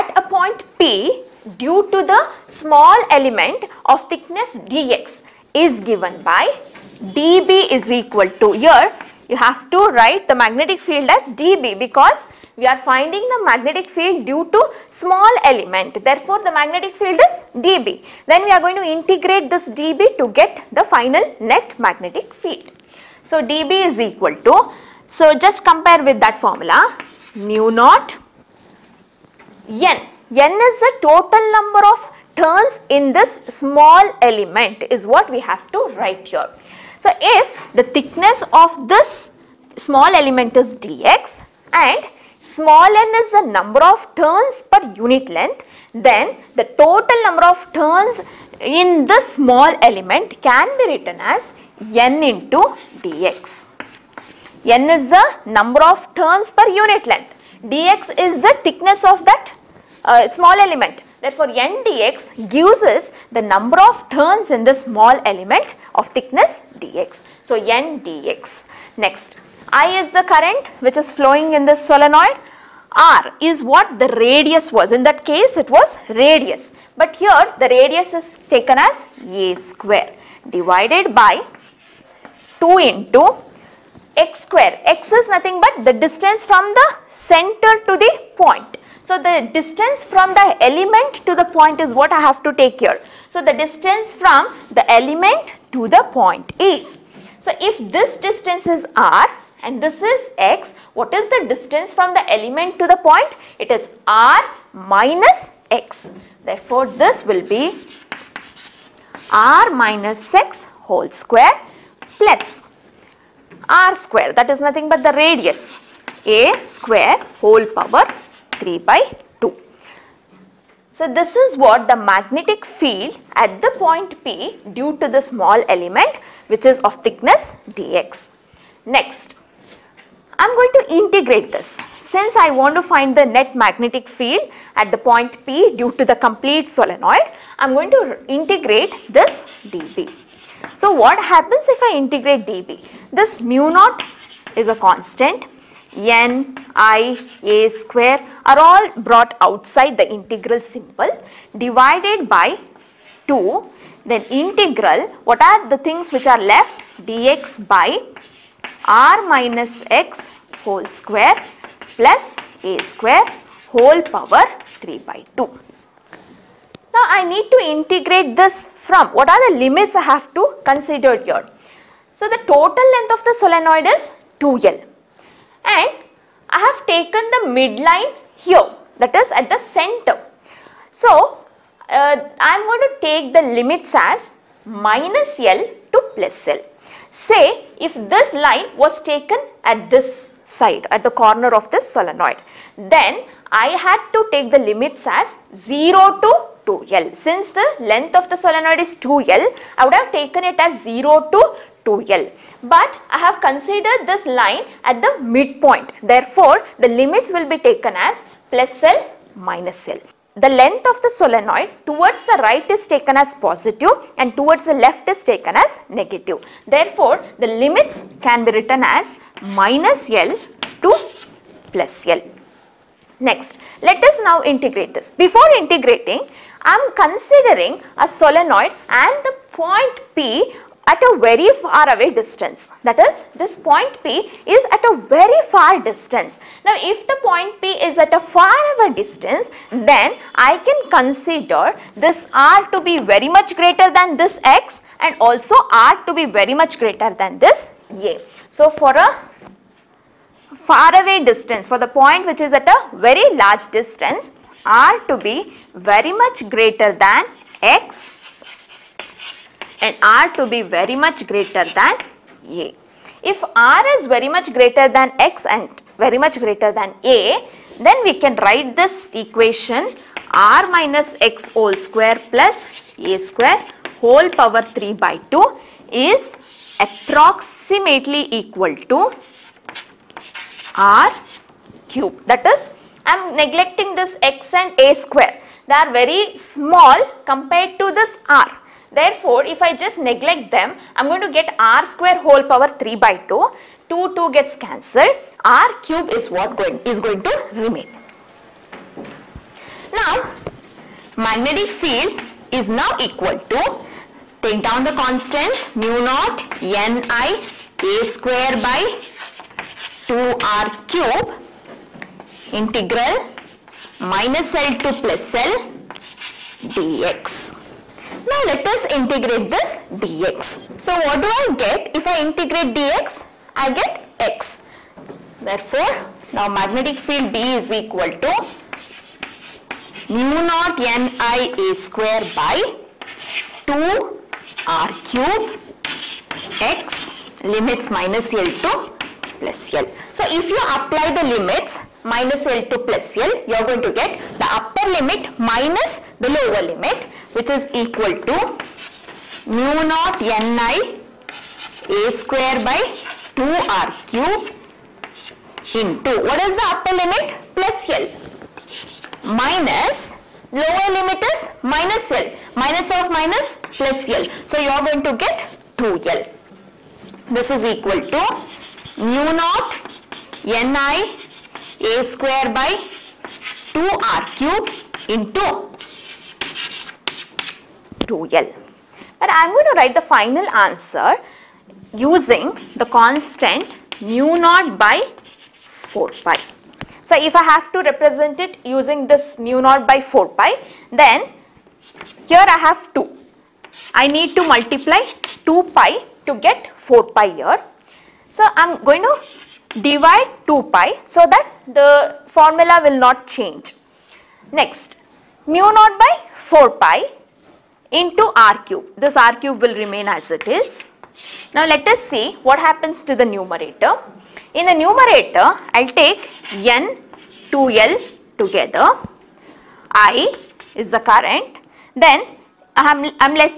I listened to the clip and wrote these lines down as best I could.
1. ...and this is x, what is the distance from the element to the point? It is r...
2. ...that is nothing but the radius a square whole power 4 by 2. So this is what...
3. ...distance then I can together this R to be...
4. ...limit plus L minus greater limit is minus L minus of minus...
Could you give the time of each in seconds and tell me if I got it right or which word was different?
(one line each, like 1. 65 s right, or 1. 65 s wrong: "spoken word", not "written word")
1. 99 s right
2. 114 s wrong: "3", not "4"
3. 238 s wrong: "consider", not "together"
4. 356 s wrong: "lower", not "greater".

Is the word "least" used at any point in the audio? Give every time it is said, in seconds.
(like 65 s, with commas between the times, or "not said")
not said.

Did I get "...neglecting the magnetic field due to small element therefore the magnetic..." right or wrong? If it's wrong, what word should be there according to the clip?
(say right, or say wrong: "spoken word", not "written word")
wrong: "finding", not "neglecting".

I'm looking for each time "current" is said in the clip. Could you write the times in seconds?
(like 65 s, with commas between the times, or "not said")
70 s, 420 s.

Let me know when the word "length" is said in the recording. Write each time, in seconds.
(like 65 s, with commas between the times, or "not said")
45 s, 57 s, 172 s, 197 s, 210 s.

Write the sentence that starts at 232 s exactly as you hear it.
That is this point P is at a very far distance.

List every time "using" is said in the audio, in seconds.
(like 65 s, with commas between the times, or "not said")
382 s, 388 s.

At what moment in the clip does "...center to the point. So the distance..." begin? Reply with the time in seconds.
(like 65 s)
87 s.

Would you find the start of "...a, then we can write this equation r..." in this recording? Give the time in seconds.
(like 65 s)
267 s.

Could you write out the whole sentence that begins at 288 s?
Therefore, if I just neglect them, I am going to get r square whole power 3 by 2.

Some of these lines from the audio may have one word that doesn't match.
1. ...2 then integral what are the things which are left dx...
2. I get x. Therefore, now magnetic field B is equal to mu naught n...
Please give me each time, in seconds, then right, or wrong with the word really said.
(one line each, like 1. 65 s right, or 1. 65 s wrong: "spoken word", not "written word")
1. 153 s right
2. 323 s right.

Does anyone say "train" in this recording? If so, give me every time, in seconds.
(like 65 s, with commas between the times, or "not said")
not said.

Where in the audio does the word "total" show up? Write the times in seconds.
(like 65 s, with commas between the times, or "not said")
31 s, 46 s, 172 s.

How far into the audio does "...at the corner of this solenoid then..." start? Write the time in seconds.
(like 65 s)
190 s.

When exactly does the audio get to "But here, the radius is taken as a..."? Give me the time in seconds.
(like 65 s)
76 s.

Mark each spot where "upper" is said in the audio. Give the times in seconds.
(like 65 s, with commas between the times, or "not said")
344 s, 356 s.